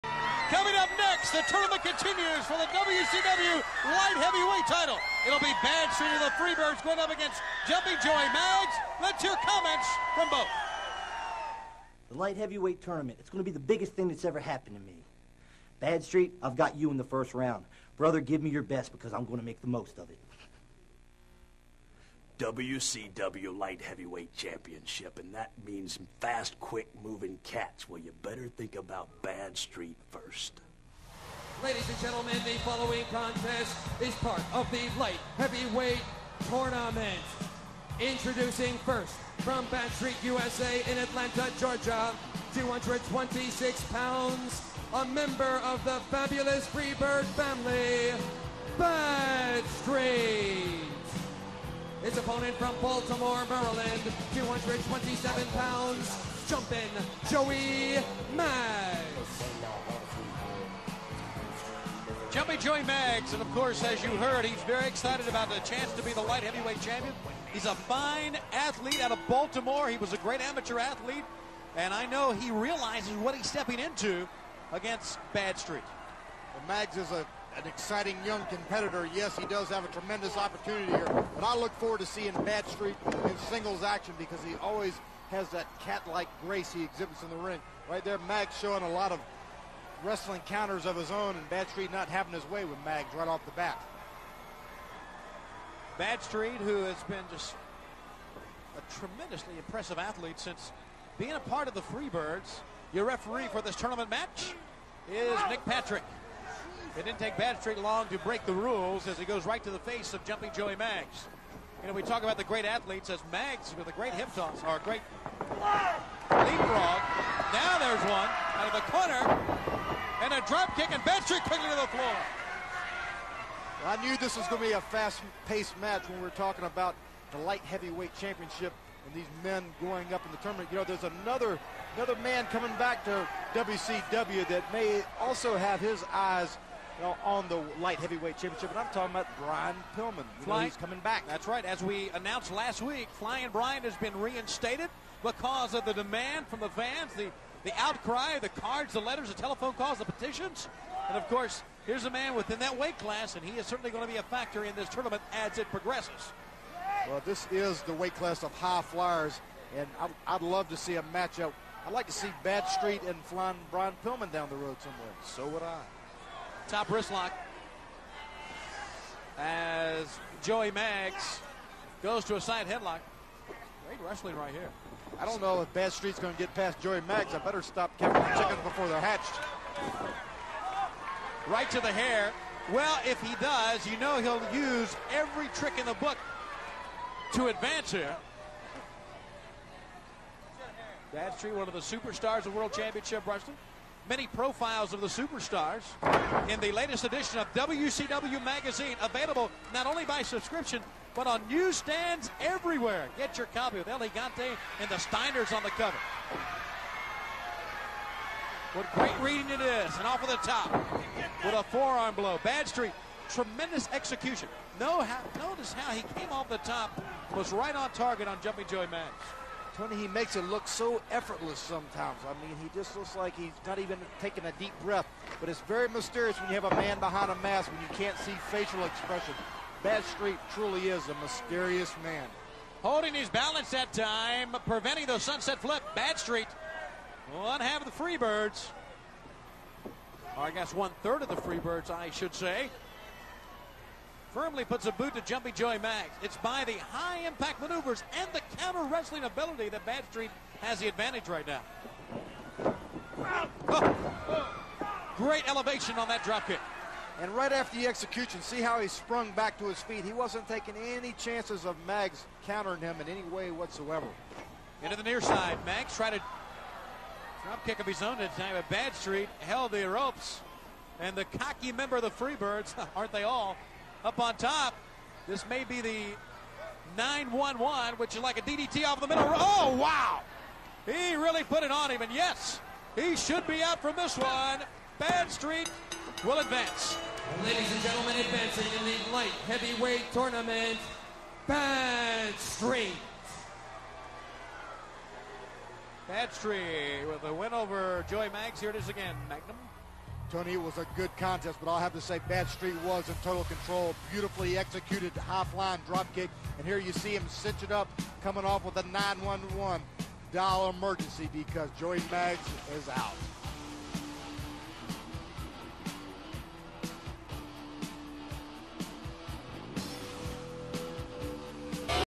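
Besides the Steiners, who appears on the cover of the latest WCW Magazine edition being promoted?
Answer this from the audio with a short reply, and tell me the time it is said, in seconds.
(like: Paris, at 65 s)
El Gigante, at 203 s.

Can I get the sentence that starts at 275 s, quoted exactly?
This may be the 9-1-1, which is like a DDT off the middle.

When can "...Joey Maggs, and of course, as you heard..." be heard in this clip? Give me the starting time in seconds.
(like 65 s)
62 s.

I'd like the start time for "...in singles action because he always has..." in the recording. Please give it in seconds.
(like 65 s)
83 s.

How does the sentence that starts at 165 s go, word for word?
So would I top wrist lock as Joey Maggs goes to a side headlock.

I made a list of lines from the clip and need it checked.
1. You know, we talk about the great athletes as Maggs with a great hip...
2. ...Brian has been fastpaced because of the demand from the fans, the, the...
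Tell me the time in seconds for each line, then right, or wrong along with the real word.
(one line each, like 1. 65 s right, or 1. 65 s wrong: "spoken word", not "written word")
1. 111 s right
2. 143 s wrong: "reinstated", not "fastpaced".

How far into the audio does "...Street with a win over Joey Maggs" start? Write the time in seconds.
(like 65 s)
296 s.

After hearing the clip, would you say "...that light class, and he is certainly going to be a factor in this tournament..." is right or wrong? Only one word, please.
wrong.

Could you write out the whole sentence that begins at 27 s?
Well, you better think about Bad Street first.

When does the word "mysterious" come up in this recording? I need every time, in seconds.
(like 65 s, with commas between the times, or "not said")
225 s, 231 s.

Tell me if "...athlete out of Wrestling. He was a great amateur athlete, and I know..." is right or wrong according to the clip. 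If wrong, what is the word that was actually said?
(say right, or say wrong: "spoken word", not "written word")
wrong: "Baltimore", not "Wrestling".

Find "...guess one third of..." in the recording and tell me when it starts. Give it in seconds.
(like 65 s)
240 s.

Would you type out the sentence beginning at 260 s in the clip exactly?
He wasn't taking any chances of Maggs countering him in any way whatsoever.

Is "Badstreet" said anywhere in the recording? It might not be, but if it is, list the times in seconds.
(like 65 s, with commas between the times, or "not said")
107 s, 121 s, 212 s, 249 s, 268 s.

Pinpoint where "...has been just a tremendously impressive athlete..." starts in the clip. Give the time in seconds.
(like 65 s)
96 s.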